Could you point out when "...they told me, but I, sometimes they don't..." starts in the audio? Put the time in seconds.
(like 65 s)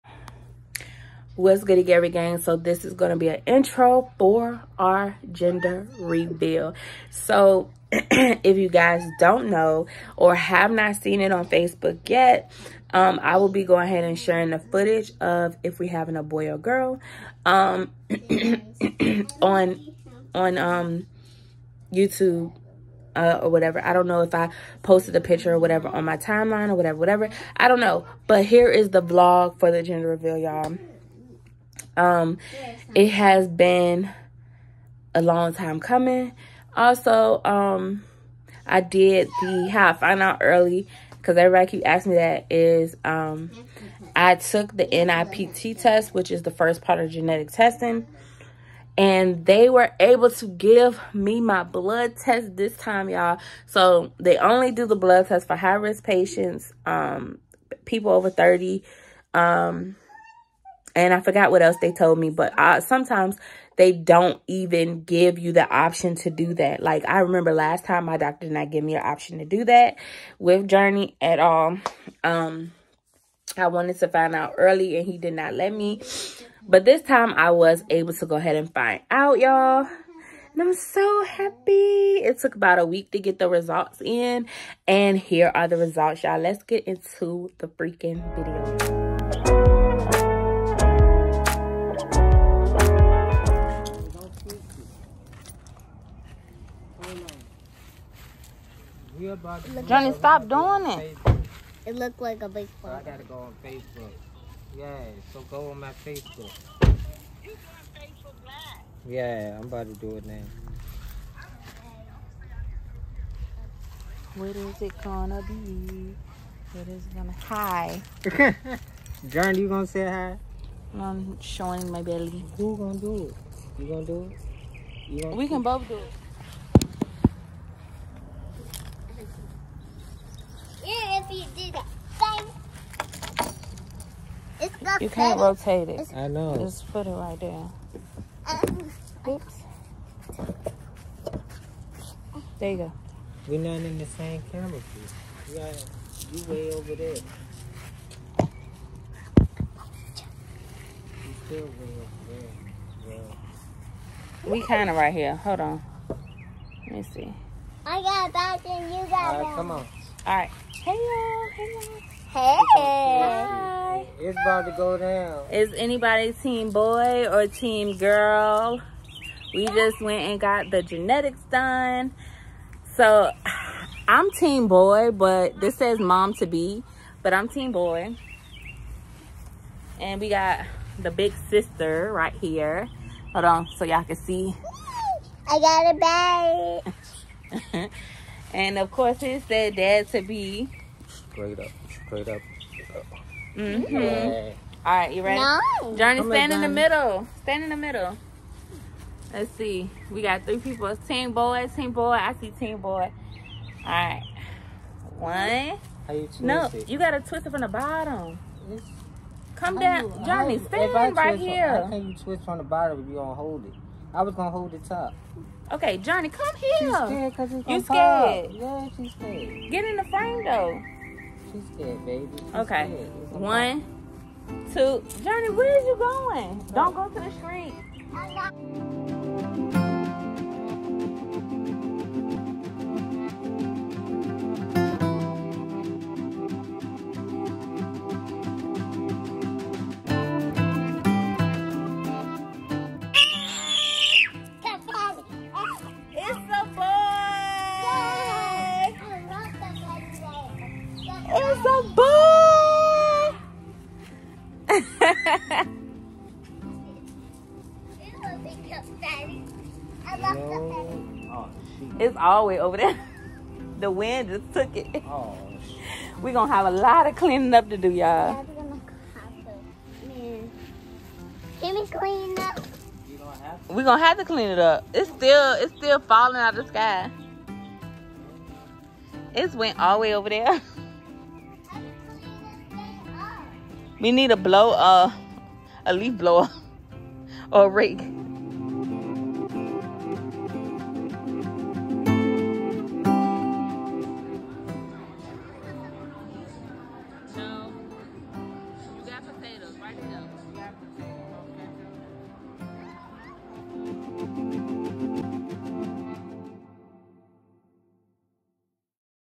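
61 s.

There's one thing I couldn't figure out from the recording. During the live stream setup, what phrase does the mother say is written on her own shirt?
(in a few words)
mom to be.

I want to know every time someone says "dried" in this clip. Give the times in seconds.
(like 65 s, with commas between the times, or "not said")
not said.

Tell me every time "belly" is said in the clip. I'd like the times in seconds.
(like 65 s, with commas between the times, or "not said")
122 s.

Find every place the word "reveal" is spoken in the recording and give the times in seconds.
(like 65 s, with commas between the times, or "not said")
5 s, 30 s.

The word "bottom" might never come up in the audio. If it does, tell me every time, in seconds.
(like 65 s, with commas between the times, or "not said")
207 s, 212 s.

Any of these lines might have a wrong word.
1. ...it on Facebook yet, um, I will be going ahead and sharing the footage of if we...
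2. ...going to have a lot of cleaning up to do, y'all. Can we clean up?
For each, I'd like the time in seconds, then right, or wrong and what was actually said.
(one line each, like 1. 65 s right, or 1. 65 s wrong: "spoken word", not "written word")
1. 11 s right
2. 266 s right.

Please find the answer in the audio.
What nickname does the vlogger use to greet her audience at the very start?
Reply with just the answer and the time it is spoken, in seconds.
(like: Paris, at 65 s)
Gary Gang, at 1 s.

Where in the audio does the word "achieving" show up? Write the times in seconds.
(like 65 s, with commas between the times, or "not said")
not said.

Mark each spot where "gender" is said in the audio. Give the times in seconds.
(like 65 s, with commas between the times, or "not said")
5 s, 29 s.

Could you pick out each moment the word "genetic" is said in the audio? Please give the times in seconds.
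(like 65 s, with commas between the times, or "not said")
47 s, 170 s.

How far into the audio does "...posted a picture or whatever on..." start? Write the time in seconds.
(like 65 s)
24 s.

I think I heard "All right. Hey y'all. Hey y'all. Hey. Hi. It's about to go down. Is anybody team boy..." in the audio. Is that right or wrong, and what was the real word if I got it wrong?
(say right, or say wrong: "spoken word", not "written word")
right.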